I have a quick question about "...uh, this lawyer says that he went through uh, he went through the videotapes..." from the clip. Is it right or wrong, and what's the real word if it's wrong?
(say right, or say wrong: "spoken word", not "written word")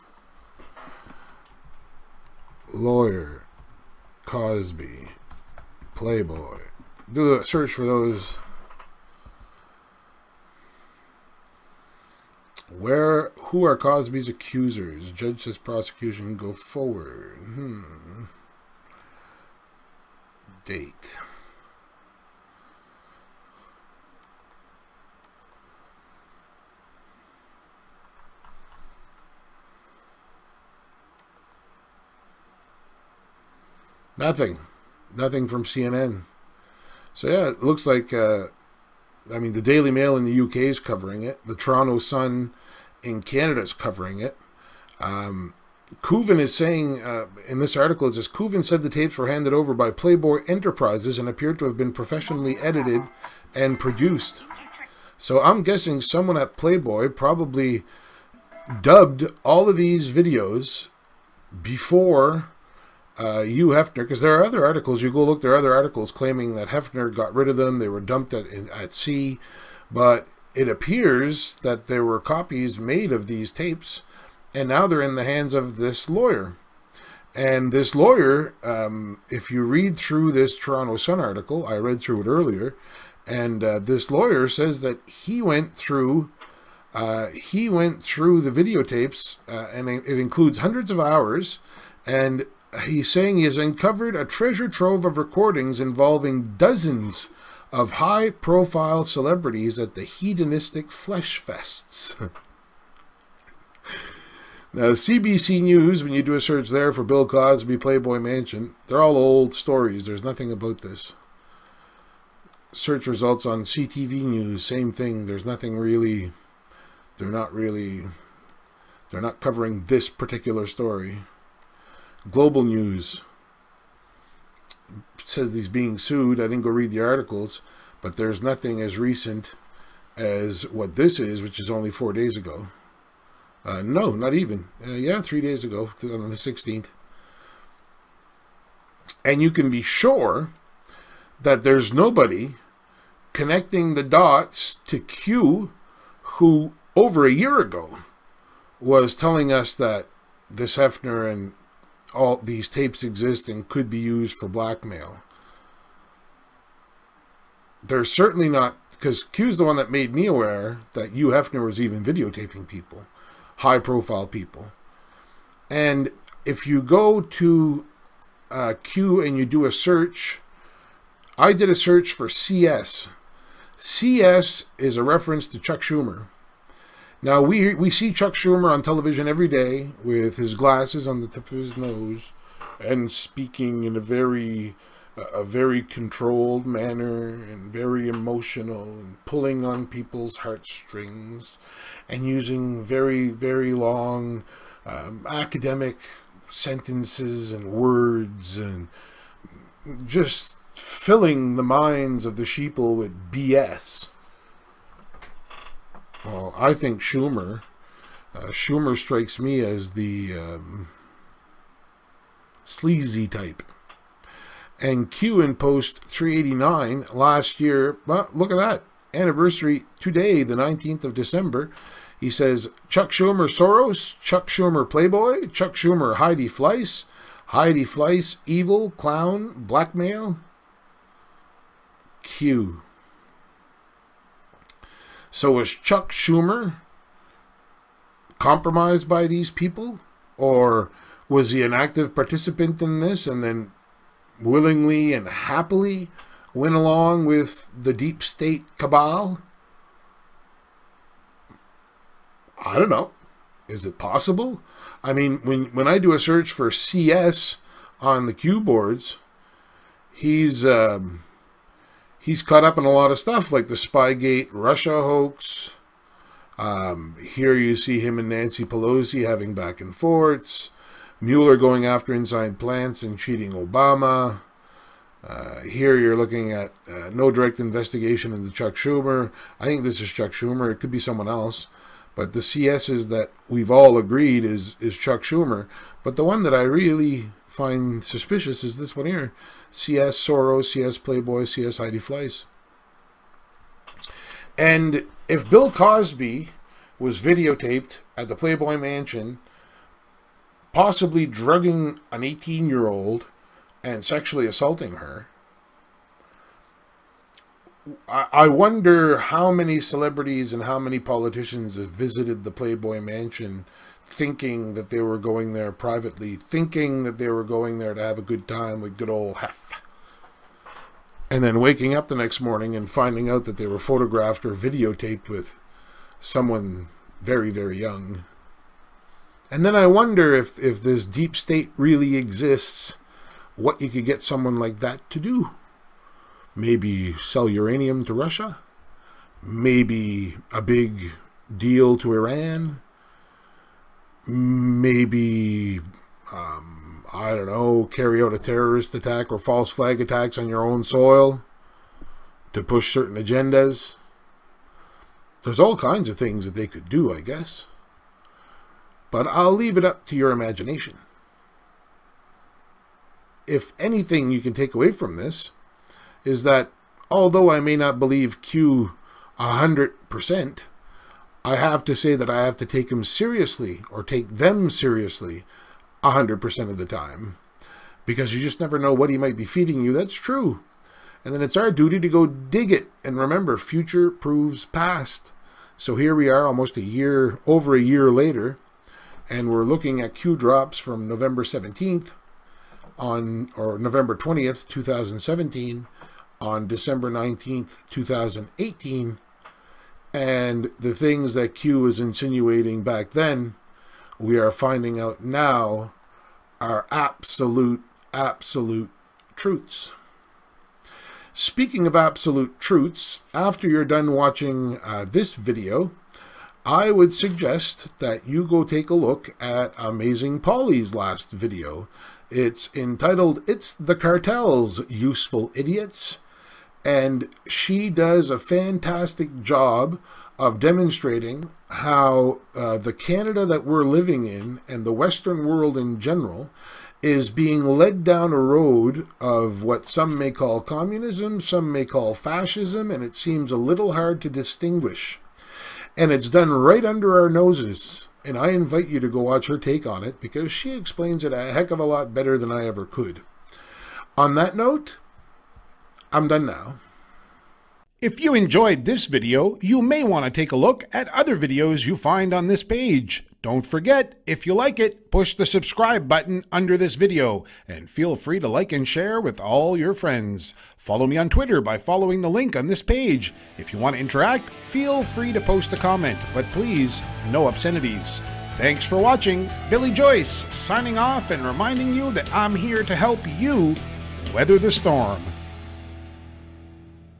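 right.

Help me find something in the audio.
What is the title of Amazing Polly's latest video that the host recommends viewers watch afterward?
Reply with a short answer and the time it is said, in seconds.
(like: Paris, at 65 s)
It's the Cartel's Useful Idiots, at 423 s.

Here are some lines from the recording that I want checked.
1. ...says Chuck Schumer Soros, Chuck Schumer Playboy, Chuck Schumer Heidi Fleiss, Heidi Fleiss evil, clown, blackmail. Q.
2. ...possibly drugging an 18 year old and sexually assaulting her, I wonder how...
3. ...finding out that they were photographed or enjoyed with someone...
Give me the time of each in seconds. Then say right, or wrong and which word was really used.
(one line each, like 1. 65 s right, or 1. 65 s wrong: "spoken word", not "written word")
1. 222 s right
2. 300 s right
3. 322 s wrong: "videotaped", not "enjoyed".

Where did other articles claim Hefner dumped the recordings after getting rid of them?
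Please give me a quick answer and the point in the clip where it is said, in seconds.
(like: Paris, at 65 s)
At sea, at 68 s.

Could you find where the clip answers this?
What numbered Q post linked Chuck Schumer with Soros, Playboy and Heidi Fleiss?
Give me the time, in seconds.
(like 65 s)
216 s.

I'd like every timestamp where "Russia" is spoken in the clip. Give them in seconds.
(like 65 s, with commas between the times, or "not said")
264 s, 338 s.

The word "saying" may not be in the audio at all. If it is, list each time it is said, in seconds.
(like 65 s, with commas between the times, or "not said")
46 s, 93 s.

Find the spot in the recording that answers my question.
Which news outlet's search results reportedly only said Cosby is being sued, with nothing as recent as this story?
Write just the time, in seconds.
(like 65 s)
122 s.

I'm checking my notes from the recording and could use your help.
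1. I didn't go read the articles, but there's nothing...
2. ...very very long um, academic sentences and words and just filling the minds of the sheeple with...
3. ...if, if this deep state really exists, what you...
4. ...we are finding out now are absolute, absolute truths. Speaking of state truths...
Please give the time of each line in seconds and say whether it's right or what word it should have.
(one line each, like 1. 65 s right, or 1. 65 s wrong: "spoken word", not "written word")
1. 126 s right
2. 192 s right
3. 330 s right
4. 404 s wrong: "absolute", not "state".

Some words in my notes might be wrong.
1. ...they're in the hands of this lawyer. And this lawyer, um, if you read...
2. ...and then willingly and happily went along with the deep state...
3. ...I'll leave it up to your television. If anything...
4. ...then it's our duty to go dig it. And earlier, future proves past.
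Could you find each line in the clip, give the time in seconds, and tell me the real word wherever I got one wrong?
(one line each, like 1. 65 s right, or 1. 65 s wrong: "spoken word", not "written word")
1. 74 s right
2. 243 s right
3. 359 s wrong: "imagination", not "television"
4. 381 s wrong: "remember", not "earlier".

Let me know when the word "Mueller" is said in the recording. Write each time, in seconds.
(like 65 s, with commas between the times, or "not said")
271 s.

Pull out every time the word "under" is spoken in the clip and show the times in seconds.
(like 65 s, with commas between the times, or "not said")
446 s, 466 s.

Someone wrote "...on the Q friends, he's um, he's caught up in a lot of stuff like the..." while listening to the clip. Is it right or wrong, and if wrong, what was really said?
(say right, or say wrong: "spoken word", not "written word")
wrong: "boards", not "friends".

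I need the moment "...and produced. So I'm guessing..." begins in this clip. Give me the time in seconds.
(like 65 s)
53 s.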